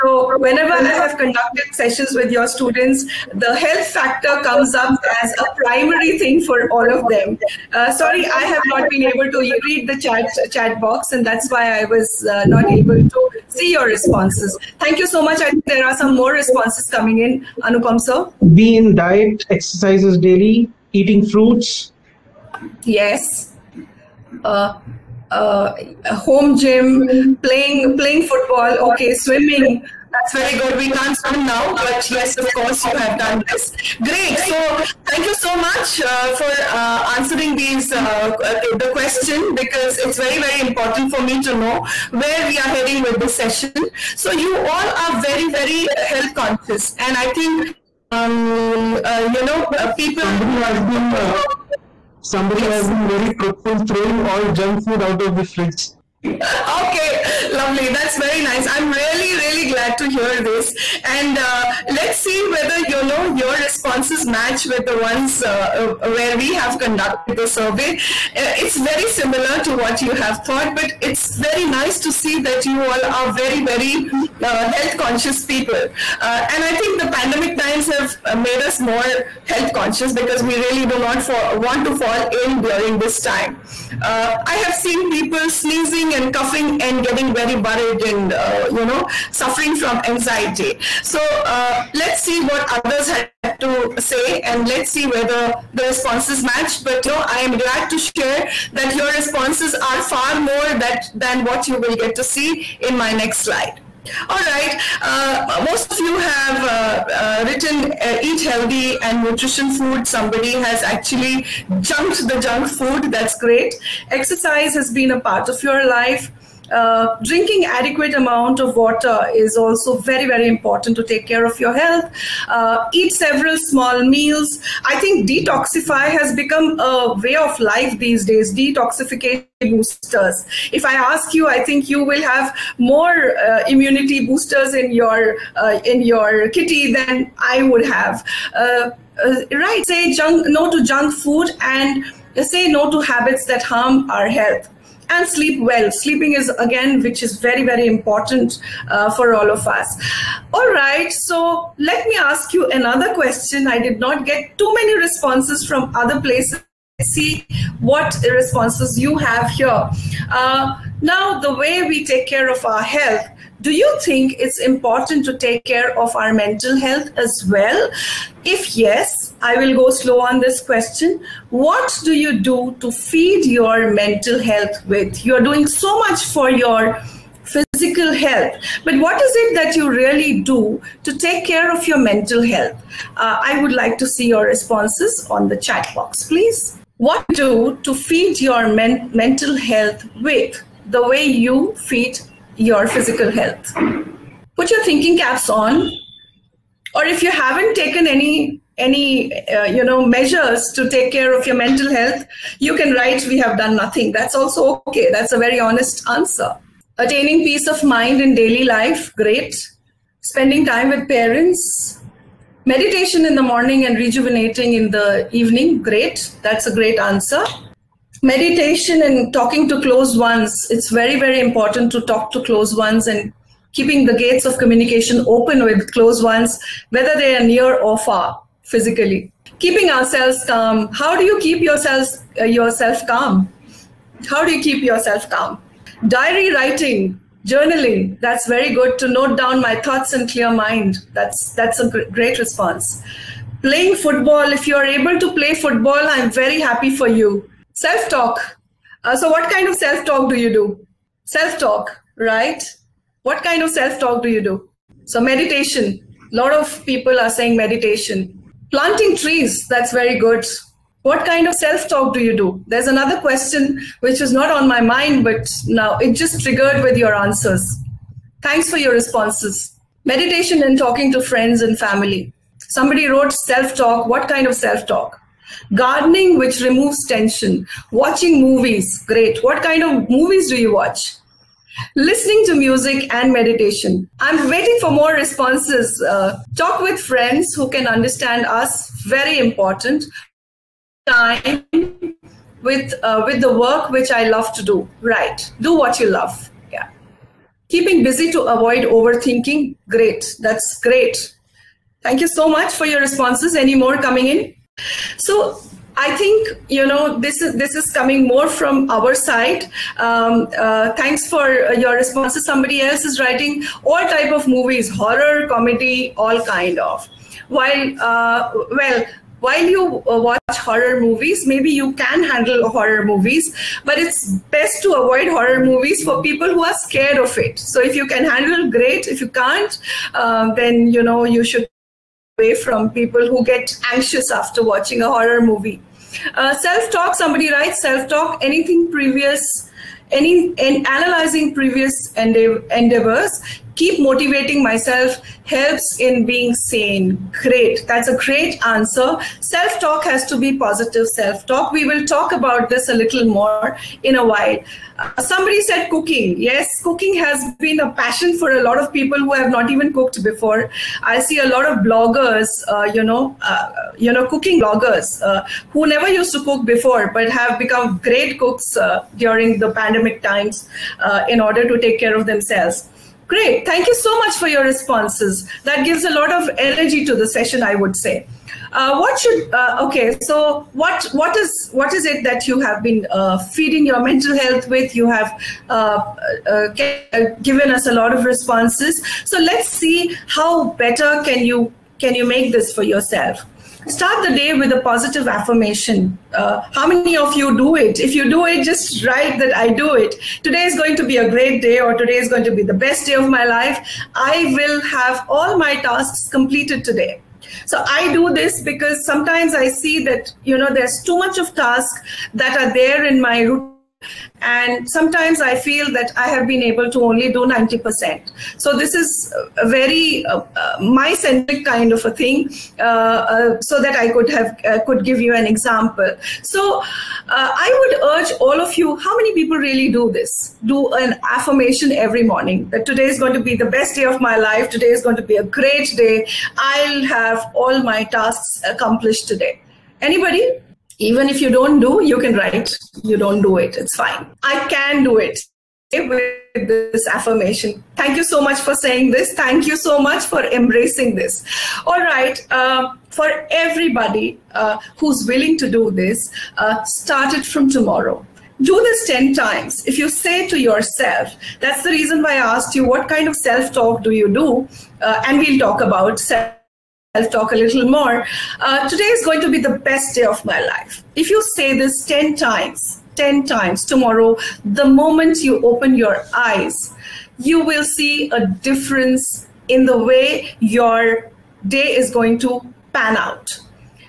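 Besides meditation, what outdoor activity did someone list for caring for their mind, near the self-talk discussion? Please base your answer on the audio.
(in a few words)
planting trees.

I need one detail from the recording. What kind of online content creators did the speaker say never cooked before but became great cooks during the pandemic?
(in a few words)
cooking bloggers.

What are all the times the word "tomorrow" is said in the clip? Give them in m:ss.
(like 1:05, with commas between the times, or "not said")
7:37, 7:53.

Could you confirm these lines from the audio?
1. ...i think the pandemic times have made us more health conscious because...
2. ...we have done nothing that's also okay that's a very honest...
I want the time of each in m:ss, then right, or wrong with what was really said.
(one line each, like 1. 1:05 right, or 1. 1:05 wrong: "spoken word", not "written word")
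1. 1:16 right
2. 3:23 right.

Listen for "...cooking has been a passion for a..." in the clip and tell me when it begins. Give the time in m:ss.
5:56.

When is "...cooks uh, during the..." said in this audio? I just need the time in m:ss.
6:08.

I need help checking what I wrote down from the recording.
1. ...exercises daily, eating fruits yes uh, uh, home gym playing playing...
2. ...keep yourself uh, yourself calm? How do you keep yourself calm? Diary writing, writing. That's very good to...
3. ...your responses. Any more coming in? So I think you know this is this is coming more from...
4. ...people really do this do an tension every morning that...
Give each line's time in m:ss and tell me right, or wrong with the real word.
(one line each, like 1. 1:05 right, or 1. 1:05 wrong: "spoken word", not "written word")
1. 0:19 right
2. 3:51 wrong: "journaling", not "writing"
3. 5:02 right
4. 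7:09 wrong: "affirmation", not "tension".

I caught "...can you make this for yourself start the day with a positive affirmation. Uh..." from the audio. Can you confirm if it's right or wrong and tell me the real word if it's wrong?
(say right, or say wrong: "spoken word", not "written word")
right.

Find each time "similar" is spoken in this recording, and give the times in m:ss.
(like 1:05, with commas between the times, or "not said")
1:09.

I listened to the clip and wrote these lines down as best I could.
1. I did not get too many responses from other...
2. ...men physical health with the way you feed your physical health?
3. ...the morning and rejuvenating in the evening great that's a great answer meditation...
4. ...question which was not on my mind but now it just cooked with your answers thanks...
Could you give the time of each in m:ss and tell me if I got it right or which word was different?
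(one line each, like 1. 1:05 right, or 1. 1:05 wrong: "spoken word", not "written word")
1. 2:33 right
2. 3:08 wrong: "mental", not "physical"
3. 3:33 right
4. 4:23 wrong: "triggered", not "cooked".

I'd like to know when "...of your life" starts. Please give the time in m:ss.
1:55.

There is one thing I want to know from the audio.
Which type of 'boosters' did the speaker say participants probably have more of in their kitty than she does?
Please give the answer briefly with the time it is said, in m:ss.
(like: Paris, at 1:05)
immunity boosters, at 2:13.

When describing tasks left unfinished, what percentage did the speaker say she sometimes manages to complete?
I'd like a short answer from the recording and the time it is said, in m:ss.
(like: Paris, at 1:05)
90%, at 6:57.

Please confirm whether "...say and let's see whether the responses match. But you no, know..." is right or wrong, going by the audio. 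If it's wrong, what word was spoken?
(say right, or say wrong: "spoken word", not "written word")
right.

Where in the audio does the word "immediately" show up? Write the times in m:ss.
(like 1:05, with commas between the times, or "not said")
not said.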